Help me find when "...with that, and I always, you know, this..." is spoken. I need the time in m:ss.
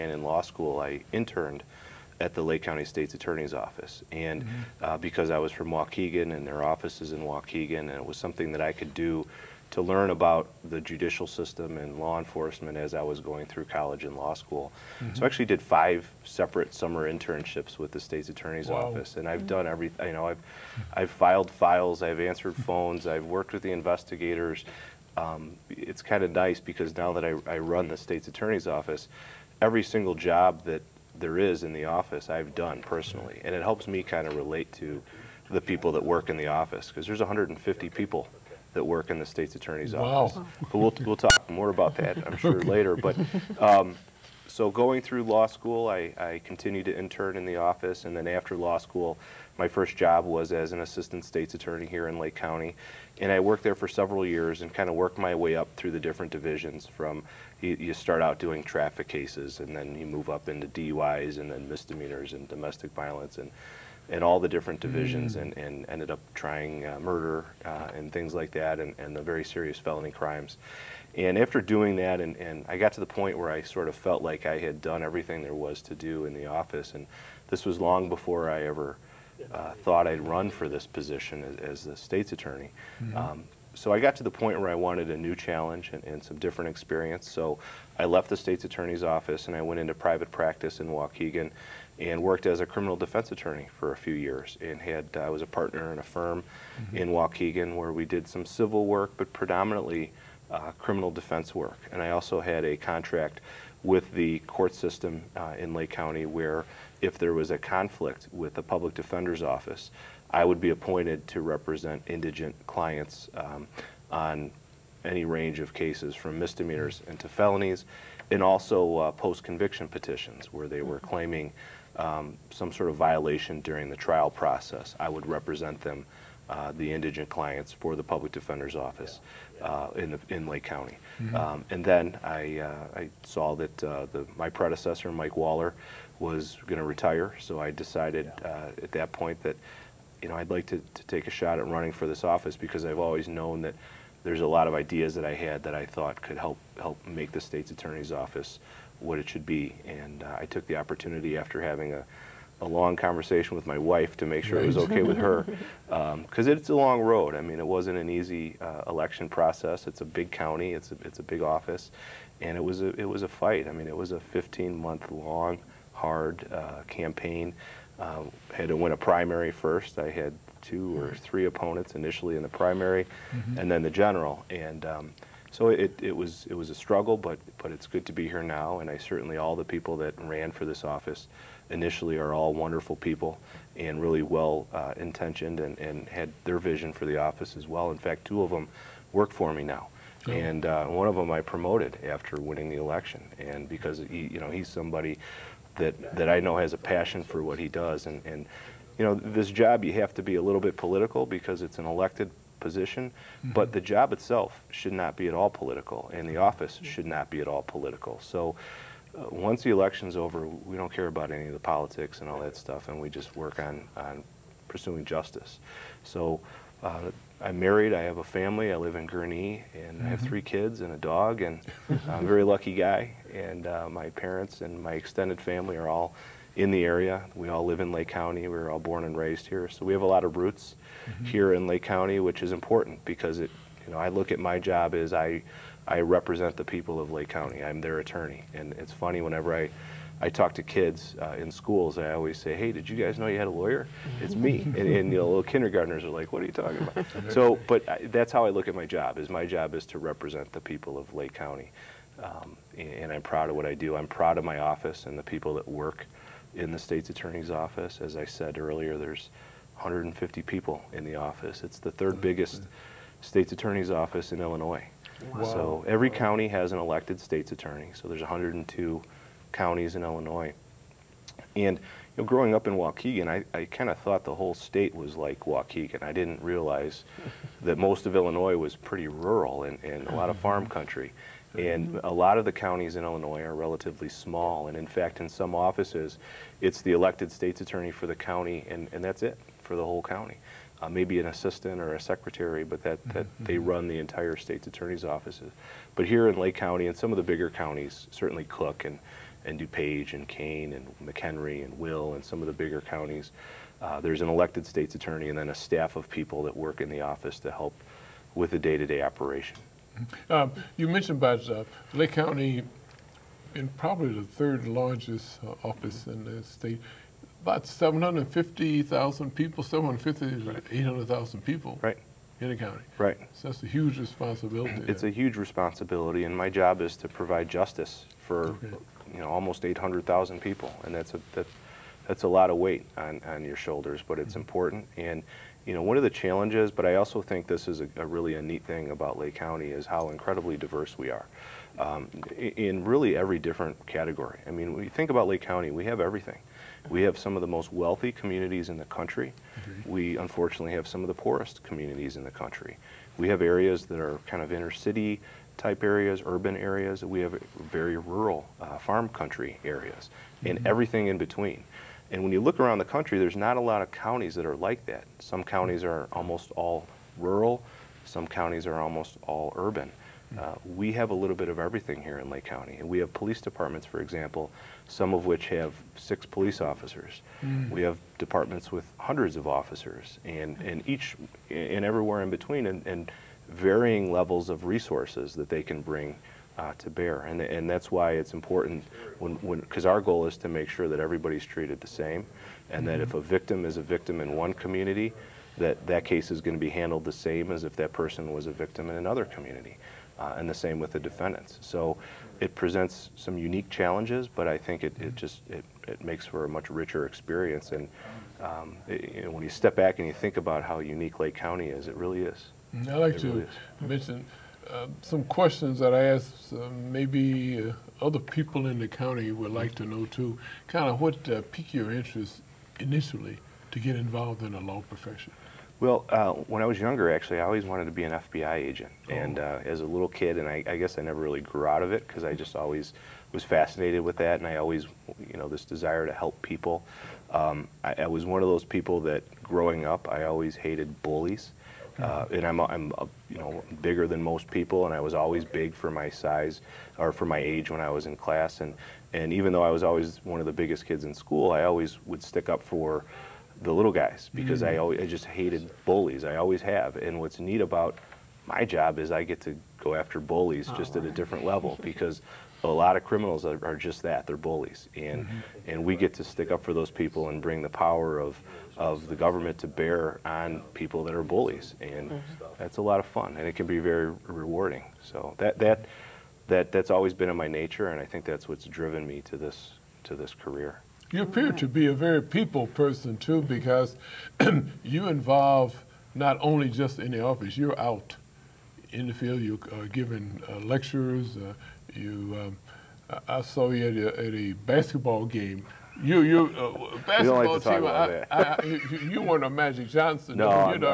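7:14.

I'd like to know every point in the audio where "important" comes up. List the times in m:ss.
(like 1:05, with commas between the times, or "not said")
3:52, 5:34, 6:28.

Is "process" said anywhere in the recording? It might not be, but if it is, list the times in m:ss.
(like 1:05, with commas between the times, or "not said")
2:04, 2:39.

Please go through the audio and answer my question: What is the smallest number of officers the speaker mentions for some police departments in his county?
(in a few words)
6.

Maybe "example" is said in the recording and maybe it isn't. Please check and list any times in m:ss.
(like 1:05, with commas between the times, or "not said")
6:14.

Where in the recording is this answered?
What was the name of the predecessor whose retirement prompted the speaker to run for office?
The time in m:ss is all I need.
2:15.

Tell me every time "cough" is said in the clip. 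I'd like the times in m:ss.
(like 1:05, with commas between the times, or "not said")
not said.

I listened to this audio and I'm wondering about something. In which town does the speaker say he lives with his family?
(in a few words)
Gurnee.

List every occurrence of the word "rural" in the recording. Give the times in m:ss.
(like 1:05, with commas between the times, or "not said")
4:39, 5:57, 6:07.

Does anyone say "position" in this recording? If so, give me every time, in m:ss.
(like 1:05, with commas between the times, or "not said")
1:20, 3:22.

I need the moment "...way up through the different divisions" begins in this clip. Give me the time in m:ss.
0:55.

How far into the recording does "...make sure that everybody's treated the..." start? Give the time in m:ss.
6:30.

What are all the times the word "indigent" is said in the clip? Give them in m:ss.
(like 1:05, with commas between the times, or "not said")
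1:52, 2:06.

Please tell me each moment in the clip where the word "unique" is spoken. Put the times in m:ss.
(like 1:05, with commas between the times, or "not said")
6:43, 6:50.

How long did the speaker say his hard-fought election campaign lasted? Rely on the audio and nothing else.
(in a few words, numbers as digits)
15 months.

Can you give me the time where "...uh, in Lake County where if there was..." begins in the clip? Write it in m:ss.
1:45.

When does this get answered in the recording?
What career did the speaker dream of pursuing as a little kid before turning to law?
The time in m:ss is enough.
7:08.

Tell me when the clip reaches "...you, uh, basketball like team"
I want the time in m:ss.
8:16.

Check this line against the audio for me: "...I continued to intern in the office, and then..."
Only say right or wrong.
right.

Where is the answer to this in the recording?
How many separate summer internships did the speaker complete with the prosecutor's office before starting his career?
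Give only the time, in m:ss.
0:15.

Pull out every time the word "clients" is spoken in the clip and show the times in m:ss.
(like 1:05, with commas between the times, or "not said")
1:52, 2:07.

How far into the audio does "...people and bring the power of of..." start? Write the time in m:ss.
7:46.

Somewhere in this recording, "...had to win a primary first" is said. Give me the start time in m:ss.
2:48.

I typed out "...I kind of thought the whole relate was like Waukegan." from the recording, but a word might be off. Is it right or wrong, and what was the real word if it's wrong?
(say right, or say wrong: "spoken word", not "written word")
wrong: "state", not "relate".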